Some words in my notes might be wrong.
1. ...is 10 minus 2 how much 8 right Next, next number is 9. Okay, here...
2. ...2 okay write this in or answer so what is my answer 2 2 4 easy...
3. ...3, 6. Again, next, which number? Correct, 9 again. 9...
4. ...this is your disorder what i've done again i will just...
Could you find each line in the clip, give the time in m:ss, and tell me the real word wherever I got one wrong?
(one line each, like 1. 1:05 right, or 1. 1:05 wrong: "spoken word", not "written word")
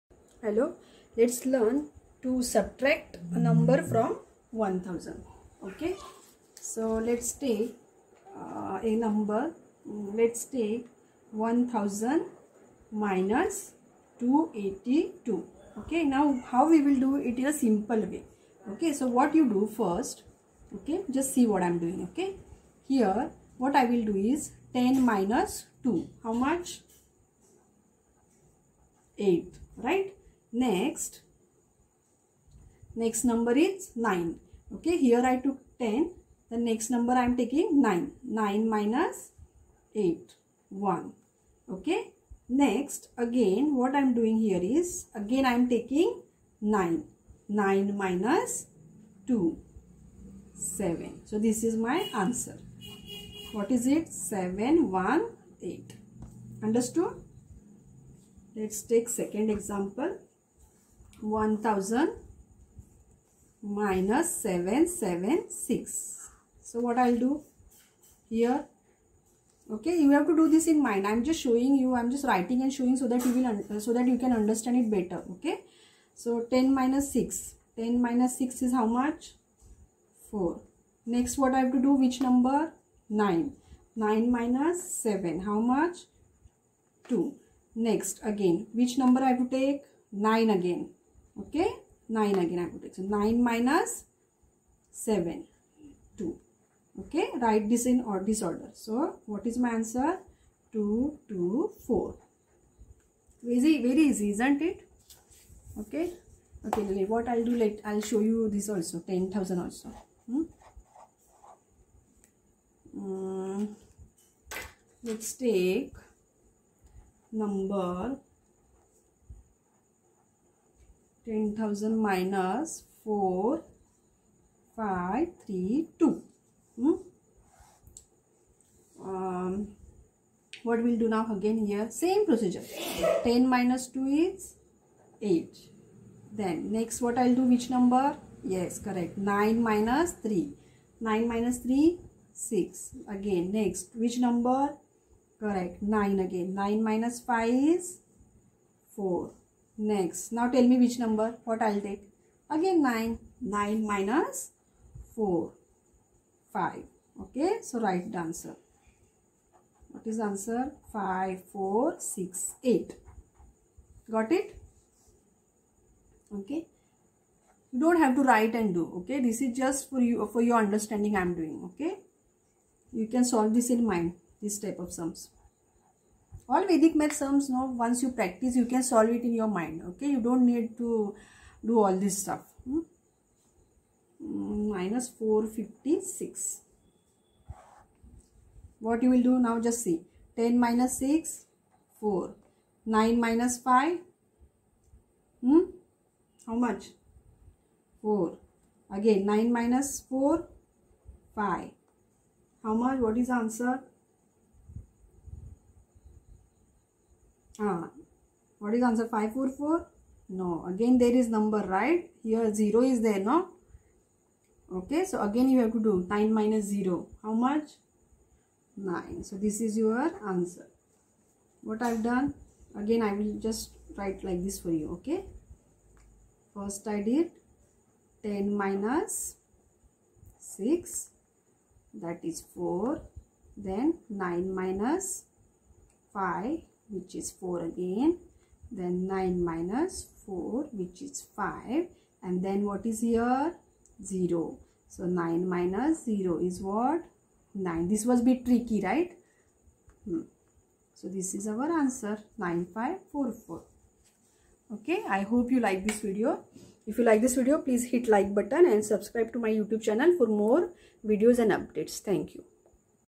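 1. 0:24 right
2. 1:36 wrong: "disorder", not "answer"
3. 2:21 right
4. 3:39 wrong: "answer", not "disorder".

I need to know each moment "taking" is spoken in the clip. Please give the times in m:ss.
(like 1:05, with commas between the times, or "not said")
0:37, 0:45.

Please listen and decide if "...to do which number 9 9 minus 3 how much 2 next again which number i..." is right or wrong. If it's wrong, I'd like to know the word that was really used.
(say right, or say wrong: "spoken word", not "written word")
wrong: "7", not "3".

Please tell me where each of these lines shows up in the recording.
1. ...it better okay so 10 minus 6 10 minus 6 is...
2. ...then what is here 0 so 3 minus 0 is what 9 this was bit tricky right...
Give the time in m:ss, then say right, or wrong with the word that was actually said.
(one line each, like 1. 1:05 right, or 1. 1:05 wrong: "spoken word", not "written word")
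1. 1:14 right
2. 4:02 wrong: "9", not "3".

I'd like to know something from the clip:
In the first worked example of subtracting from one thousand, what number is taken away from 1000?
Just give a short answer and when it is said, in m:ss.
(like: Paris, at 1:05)
282, at 0:14.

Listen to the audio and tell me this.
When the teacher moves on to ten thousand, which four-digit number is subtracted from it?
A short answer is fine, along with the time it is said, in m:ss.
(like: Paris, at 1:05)
4532, at 2:03.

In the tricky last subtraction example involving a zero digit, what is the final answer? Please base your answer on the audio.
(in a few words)
9544.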